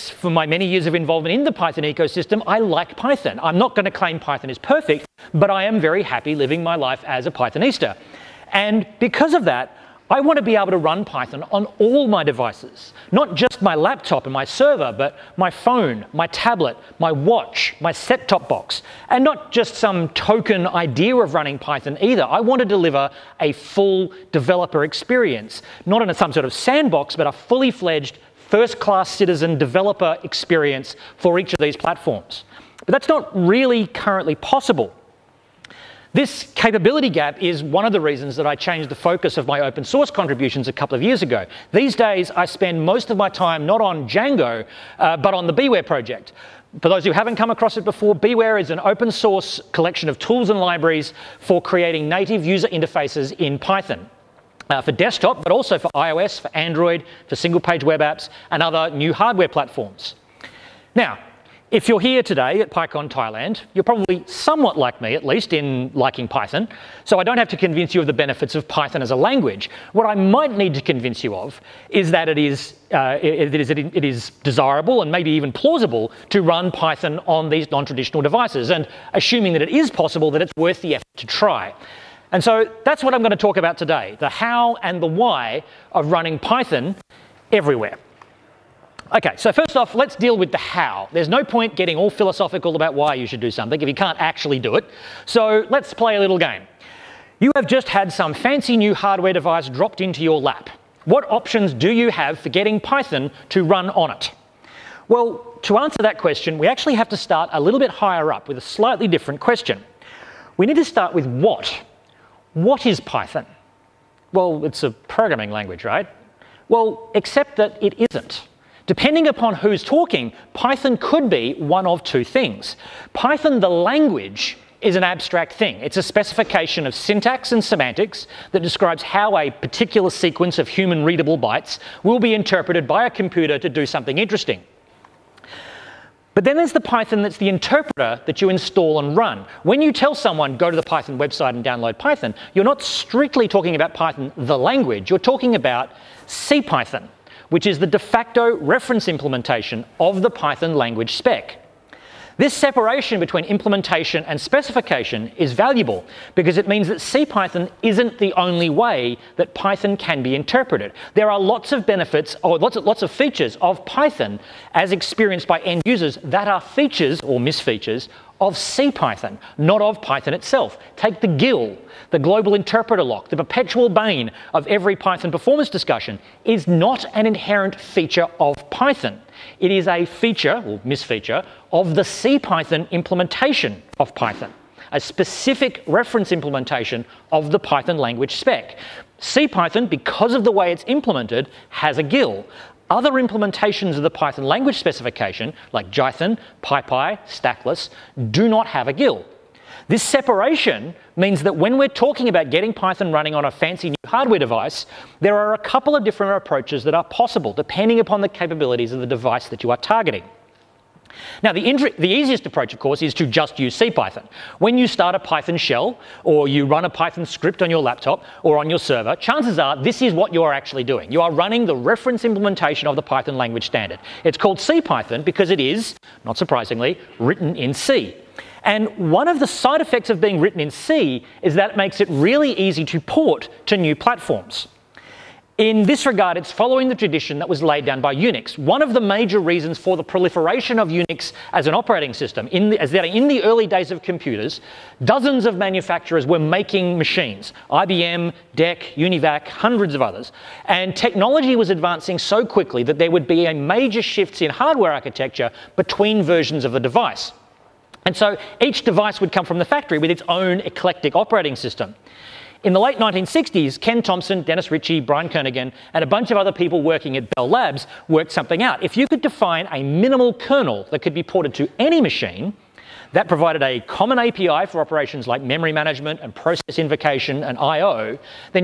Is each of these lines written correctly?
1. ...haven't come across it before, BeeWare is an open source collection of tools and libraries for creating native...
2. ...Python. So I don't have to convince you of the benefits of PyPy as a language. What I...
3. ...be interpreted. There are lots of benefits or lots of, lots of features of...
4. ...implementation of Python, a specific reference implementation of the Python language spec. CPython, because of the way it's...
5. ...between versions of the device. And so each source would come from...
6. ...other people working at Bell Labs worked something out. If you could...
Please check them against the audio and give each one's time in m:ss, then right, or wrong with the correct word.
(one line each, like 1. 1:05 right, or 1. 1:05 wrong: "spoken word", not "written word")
1. 0:47 right
2. 1:06 wrong: "Python", not "PyPy"
3. 2:40 right
4. 3:02 right
5. 4:15 wrong: "device", not "source"
6. 4:26 right.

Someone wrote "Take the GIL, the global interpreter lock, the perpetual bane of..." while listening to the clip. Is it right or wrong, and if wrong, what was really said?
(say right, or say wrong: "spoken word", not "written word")
right.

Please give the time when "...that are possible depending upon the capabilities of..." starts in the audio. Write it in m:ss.
3:26.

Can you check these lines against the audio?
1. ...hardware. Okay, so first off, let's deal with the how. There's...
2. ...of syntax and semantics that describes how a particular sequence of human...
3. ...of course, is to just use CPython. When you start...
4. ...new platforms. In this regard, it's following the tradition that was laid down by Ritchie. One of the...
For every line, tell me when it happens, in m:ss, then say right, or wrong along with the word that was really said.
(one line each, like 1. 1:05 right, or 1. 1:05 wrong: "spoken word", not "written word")
1. 1:27 wrong: "everywhere", not "hardware"
2. 2:06 right
3. 3:32 right
4. 3:53 wrong: "Unix", not "Ritchie".